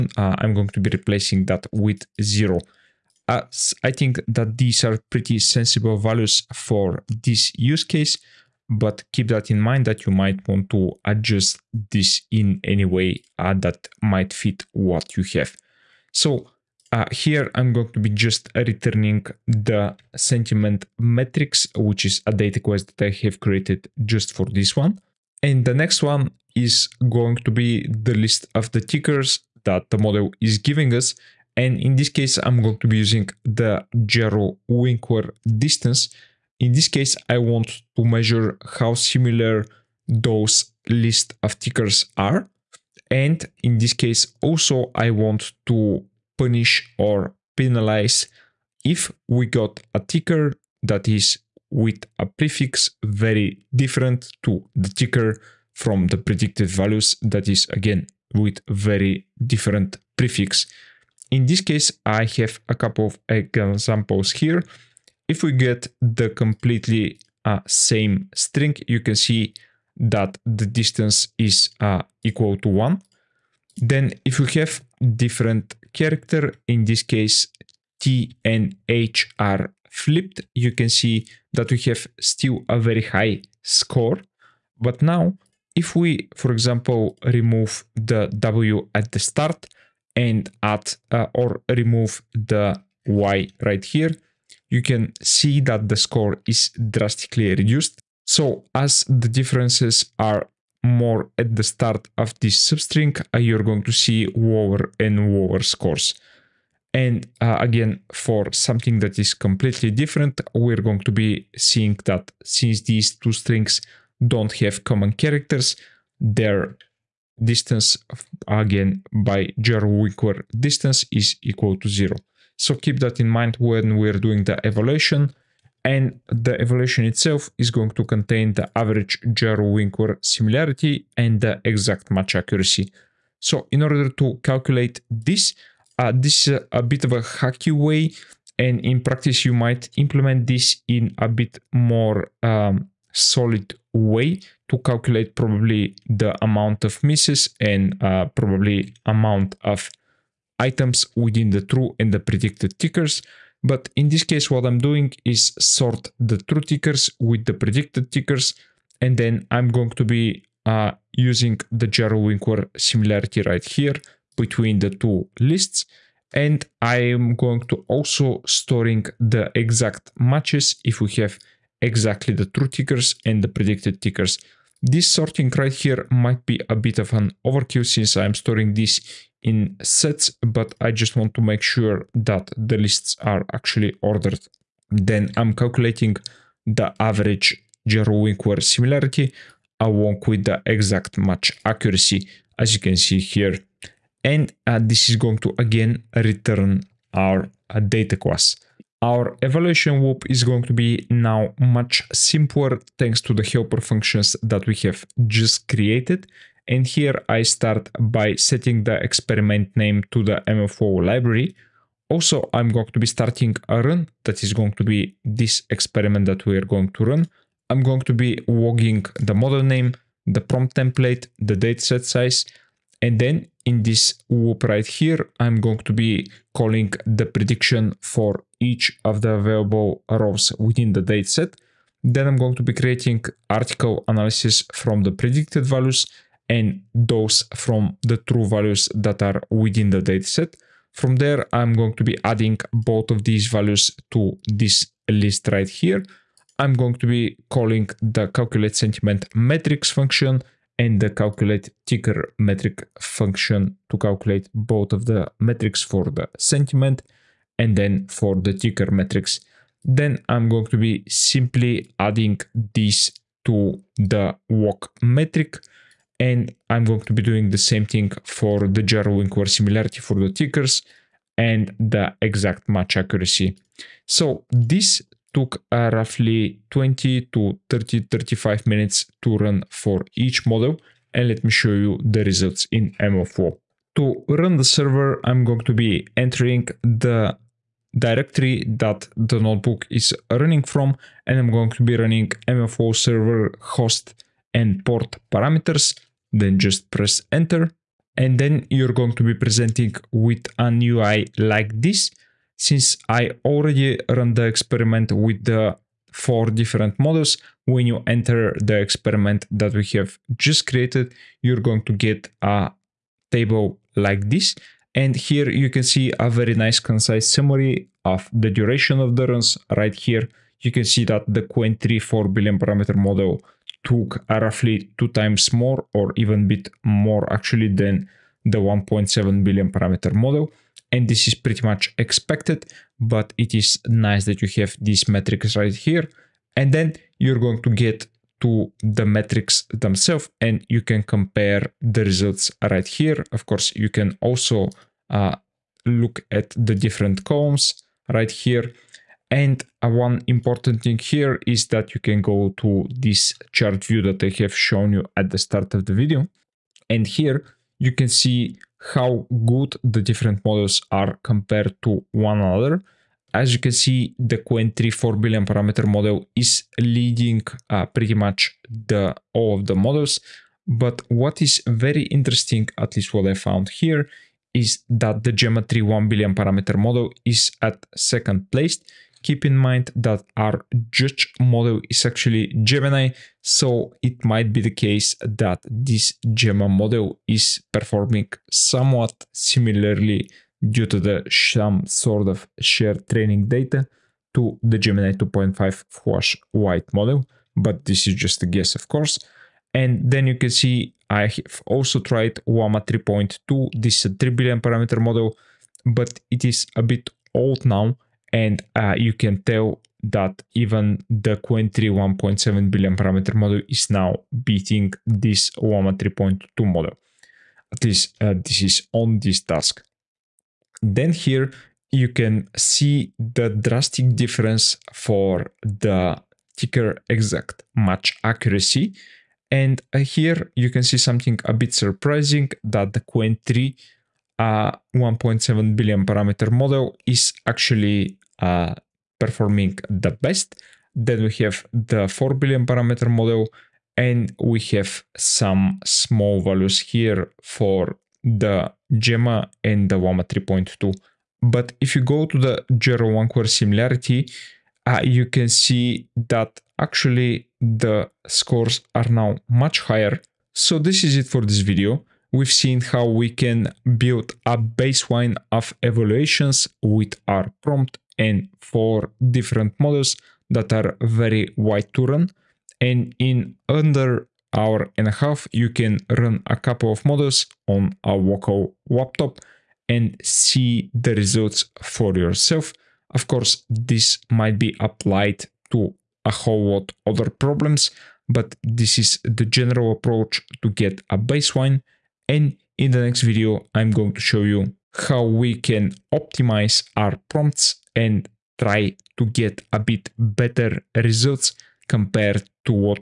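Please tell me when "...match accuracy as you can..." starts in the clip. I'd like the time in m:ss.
3:11.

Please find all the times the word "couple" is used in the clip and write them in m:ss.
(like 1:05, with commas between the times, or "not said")
1:02, 7:56.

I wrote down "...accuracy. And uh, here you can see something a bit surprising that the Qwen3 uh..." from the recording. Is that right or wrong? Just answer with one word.
right.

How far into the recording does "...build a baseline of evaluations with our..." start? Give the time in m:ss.
7:43.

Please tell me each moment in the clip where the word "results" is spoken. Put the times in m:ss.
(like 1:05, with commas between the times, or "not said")
4:42, 5:42, 8:01, 8:20.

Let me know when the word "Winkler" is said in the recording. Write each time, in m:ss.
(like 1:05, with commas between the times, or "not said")
0:34, 2:00, 2:09, 2:42, 7:33.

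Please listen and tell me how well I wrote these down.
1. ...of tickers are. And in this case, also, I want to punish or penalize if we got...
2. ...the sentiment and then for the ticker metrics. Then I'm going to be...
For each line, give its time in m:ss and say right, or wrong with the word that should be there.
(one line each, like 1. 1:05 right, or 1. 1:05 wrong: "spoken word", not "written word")
1. 0:41 right
2. 4:16 right.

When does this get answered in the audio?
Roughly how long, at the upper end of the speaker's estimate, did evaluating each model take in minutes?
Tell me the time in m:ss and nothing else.
4:38.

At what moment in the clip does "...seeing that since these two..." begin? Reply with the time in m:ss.
1:51.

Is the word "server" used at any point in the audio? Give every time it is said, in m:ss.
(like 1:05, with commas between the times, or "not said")
4:44, 4:53.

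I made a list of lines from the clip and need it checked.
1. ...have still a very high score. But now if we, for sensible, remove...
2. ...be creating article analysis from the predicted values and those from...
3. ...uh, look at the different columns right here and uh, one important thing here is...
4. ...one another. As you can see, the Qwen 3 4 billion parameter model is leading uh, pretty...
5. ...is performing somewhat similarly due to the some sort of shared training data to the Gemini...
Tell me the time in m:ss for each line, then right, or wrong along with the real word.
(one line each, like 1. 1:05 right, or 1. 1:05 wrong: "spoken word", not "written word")
1. 1:21 wrong: "example", not "sensible"
2. 3:52 right
3. 5:45 right
4. 6:02 right
5. 6:27 right.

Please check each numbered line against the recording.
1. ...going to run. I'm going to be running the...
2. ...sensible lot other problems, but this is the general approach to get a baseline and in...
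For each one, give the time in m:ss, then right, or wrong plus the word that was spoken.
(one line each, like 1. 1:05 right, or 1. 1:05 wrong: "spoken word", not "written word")
1. 3:36 wrong: "logging", not "running"
2. 8:06 wrong: "whole", not "sensible".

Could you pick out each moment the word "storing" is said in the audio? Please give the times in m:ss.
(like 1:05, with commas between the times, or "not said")
2:48, 2:58.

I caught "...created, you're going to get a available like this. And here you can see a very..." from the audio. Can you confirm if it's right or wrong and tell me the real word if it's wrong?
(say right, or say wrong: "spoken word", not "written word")
wrong: "table", not "available".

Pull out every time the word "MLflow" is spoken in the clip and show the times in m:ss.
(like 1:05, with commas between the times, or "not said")
3:30, 4:42, 4:52.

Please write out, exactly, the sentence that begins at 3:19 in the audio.
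Our evaluation loop is going to be now much simpler thanks to the helper functions that we have just created.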